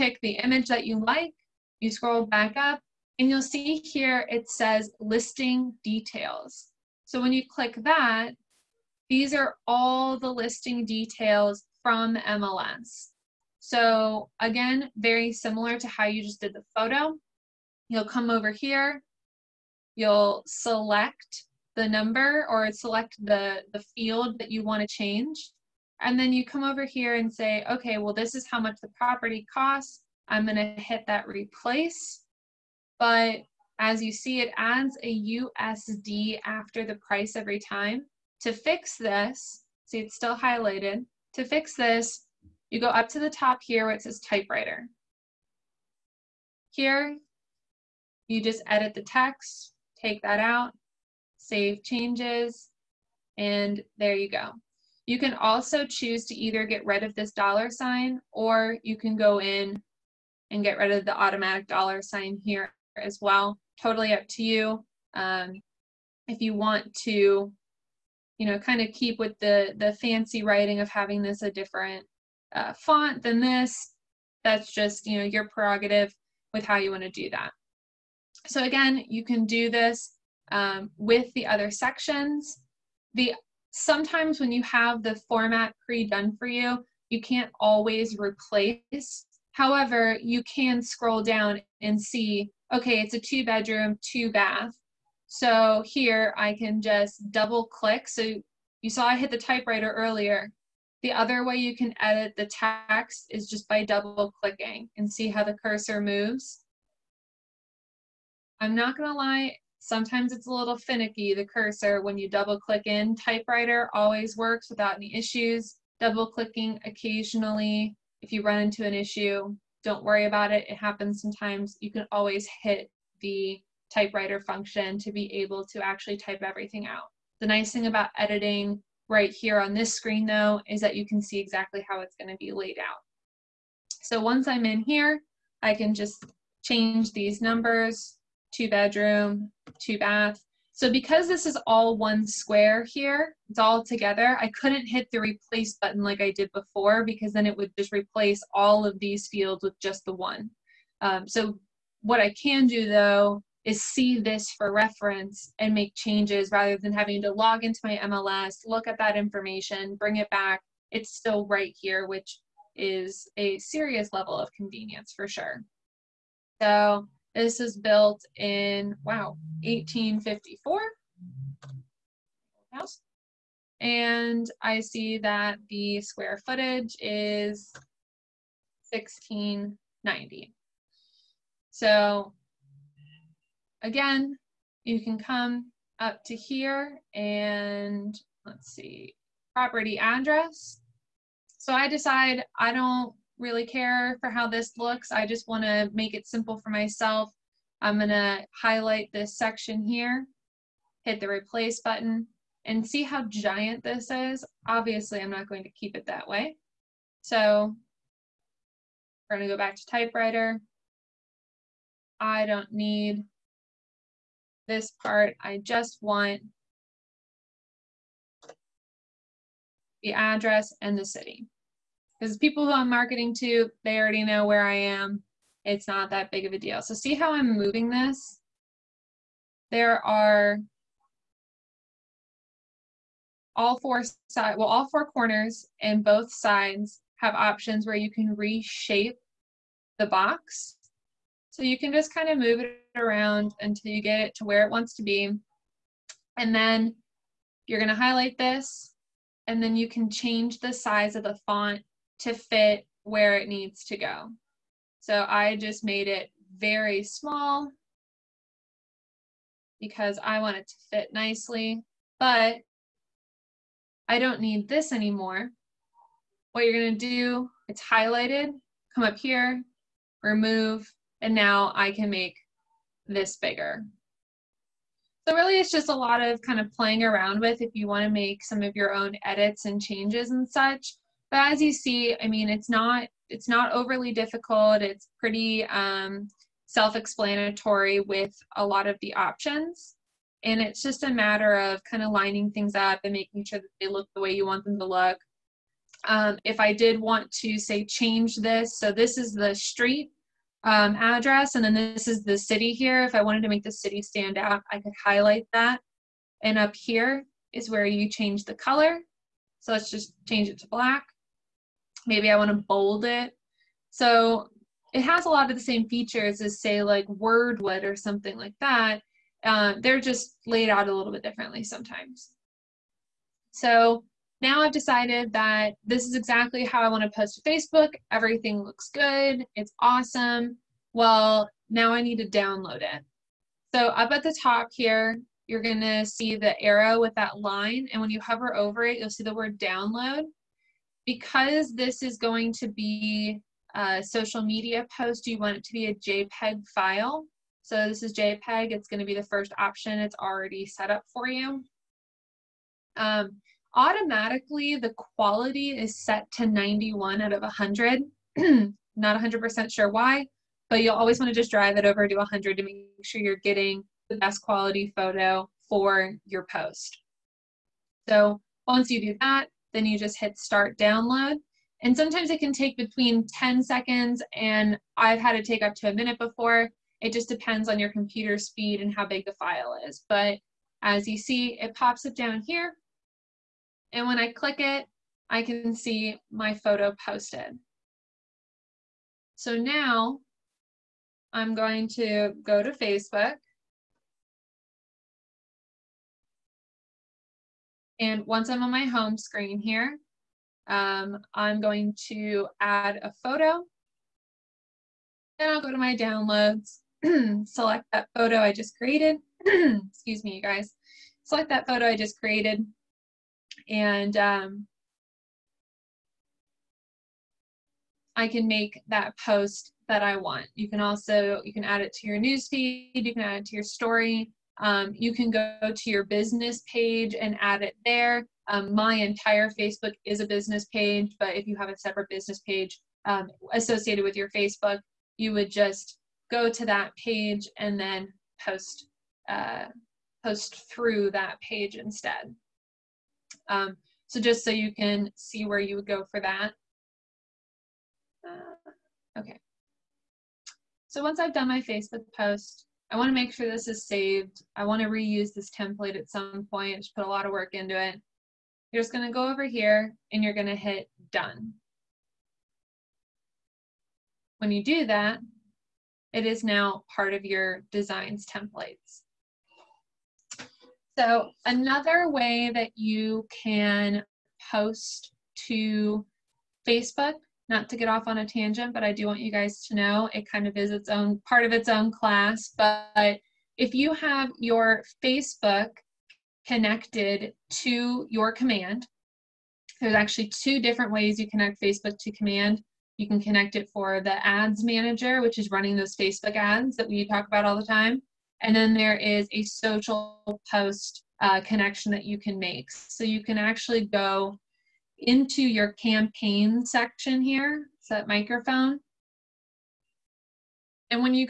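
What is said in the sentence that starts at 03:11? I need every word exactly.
So I decide I don't really care for how this looks.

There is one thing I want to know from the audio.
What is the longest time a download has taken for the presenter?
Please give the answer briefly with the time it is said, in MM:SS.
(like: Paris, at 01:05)
a minute, at 06:15.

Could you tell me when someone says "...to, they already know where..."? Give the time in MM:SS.
03:43.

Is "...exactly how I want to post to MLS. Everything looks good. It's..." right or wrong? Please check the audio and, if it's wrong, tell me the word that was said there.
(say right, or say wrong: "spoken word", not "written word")
wrong: "Facebook", not "MLS".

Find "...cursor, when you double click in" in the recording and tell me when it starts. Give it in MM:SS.
01:51.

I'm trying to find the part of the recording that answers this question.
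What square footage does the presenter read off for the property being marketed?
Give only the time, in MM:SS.
02:58.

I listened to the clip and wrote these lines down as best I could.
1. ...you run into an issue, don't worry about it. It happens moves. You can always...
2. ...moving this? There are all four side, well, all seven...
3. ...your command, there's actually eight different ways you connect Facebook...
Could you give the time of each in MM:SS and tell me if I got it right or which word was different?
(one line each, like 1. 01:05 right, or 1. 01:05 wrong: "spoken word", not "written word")
1. 01:58 wrong: "sometimes", not "moves"
2. 03:47 wrong: "four", not "seven"
3. 08:08 wrong: "two", not "eight".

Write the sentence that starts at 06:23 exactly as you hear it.
And when I click it, I can see my photo posted.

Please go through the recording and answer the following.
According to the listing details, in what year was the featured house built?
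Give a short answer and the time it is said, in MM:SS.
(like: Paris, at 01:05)
1854, at 02:49.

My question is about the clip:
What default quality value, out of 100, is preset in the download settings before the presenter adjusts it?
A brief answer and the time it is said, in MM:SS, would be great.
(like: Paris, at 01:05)
91, at 05:56.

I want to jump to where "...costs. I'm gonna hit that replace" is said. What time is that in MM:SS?
00:29.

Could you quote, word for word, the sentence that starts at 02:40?
It's still right here, which is a serious level of convenience for sure.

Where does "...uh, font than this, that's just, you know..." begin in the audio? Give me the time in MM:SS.
01:12.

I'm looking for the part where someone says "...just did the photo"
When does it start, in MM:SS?
00:16.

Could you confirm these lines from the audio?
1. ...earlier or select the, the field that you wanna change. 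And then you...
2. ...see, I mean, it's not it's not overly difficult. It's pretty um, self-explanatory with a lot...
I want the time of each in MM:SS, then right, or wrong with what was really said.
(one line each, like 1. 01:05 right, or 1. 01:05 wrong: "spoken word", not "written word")
1. 00:21 wrong: "number", not "earlier"
2. 04:41 right.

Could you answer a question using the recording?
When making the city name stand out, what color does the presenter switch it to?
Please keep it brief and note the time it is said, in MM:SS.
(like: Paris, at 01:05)
black, at 05:10.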